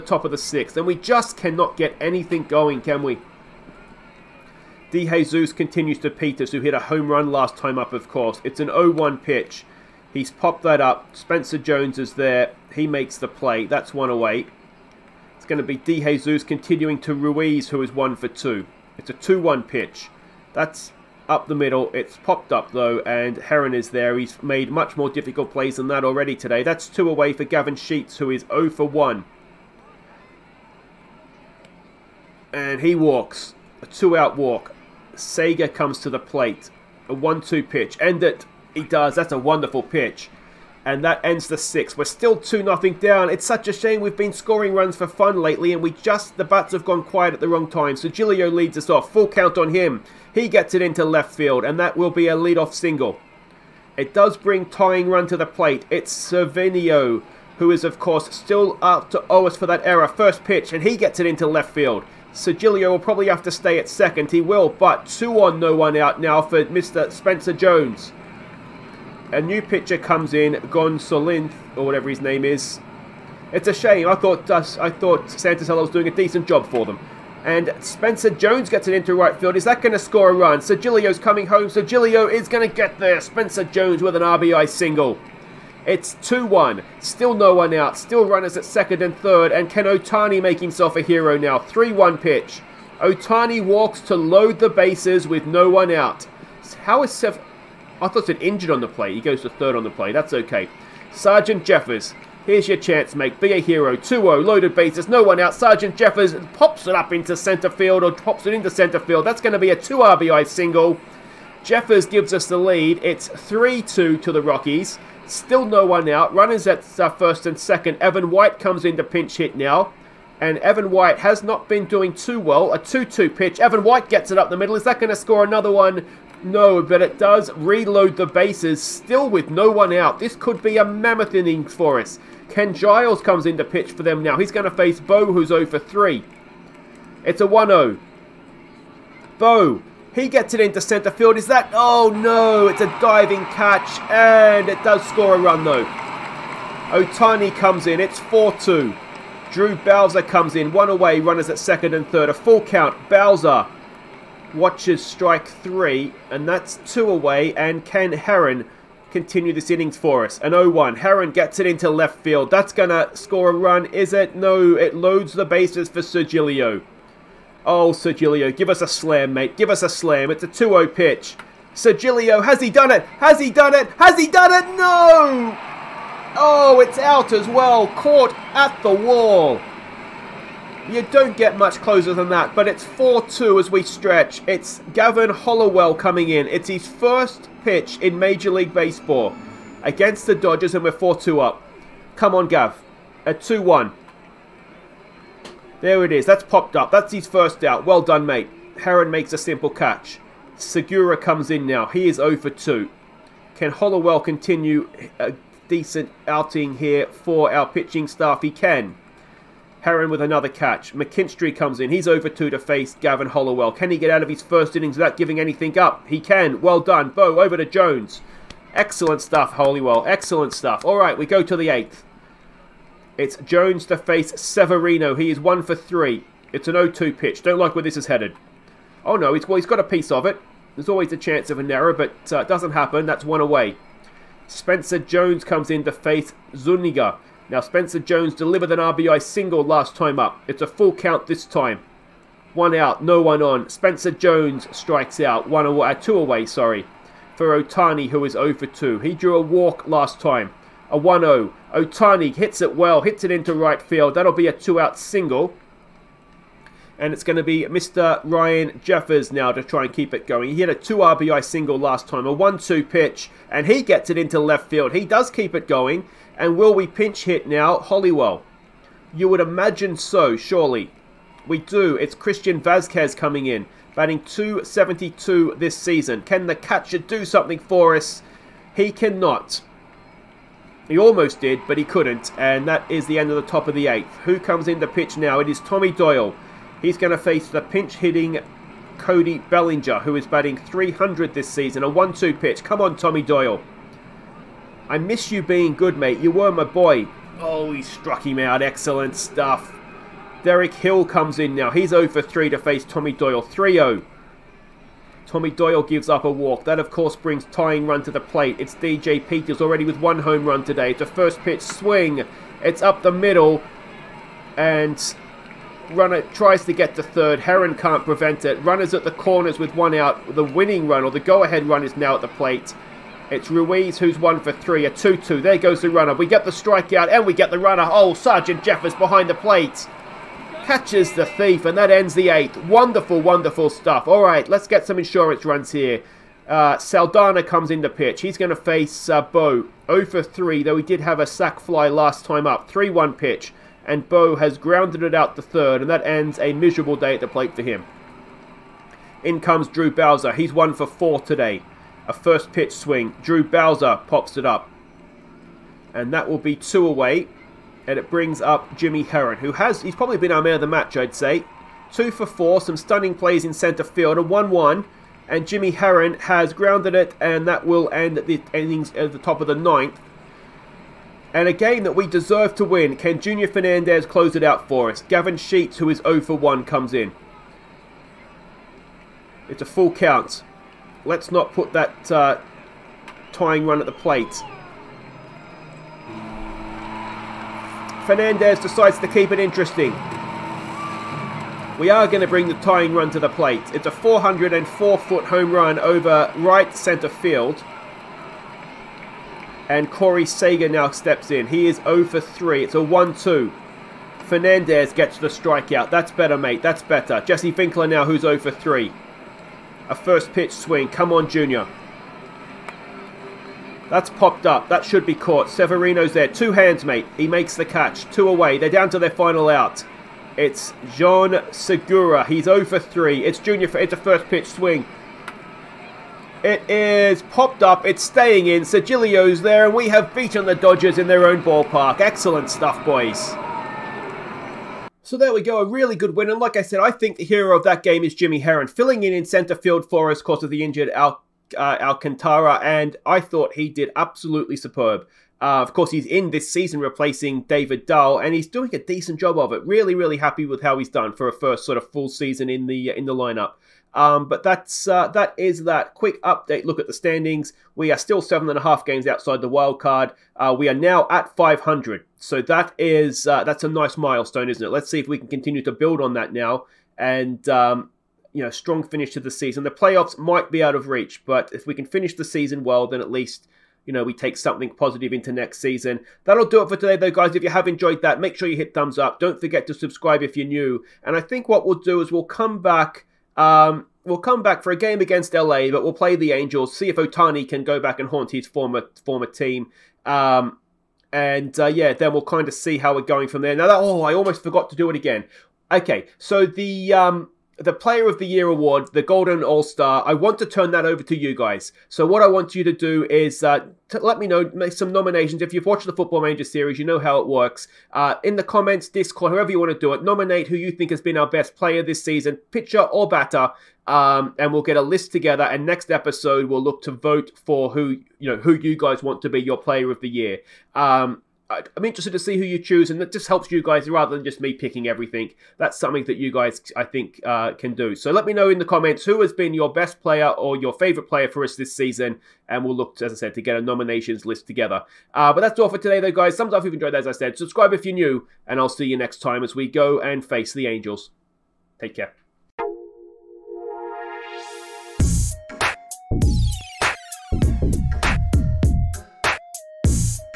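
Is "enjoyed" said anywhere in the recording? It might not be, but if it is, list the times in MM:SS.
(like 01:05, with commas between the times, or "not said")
07:57, 08:56.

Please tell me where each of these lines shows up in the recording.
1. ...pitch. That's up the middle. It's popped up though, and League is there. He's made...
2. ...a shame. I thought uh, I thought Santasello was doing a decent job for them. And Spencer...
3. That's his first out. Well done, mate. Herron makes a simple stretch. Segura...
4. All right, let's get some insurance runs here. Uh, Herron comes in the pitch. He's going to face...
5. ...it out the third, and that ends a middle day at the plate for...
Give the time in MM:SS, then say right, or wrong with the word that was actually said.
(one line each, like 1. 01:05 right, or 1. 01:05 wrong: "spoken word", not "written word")
1. 00:19 wrong: "Herron", not "League"
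2. 01:13 right
3. 03:16 wrong: "catch", not "stretch"
4. 05:34 wrong: "Saldana", not "Herron"
5. 05:45 wrong: "miserable", not "middle".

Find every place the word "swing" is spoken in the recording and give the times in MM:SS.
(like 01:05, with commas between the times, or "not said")
05:11, 05:52, 06:50, 07:04.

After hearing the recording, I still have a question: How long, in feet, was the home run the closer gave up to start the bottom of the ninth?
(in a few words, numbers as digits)
404.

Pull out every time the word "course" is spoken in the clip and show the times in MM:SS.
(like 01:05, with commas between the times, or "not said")
00:08, 00:57, 05:06, 07:25.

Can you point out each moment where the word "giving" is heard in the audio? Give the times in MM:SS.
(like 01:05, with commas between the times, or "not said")
03:35.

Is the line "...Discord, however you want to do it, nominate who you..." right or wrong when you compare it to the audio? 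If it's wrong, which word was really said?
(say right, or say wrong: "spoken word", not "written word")
right.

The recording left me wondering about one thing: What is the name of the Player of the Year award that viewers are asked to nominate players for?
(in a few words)
Golden All Star.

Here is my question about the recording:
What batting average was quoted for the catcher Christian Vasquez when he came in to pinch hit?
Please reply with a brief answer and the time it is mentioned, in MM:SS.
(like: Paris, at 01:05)
.272, at 04:34.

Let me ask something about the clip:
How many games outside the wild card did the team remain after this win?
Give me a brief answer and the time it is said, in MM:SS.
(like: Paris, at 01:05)
7.5, at 07:38.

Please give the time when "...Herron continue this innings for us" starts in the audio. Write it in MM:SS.
02:38.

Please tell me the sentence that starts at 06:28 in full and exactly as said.
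Fernandez decides to keep it interesting.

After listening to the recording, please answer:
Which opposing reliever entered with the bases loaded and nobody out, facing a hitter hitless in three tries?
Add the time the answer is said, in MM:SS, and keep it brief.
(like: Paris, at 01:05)
Ken Giles, at 02:12.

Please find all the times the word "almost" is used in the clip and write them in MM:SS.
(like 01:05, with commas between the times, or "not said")
04:40, 08:14.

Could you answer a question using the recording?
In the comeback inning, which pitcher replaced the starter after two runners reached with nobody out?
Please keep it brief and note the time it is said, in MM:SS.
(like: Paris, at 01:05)
Gonsolin, at 01:10.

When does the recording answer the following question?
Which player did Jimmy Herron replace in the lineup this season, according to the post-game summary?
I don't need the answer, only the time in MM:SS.
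07:27.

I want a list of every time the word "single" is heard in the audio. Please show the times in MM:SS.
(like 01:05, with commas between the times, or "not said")
00:52, 01:24, 01:50, 03:59, 04:14, 04:21.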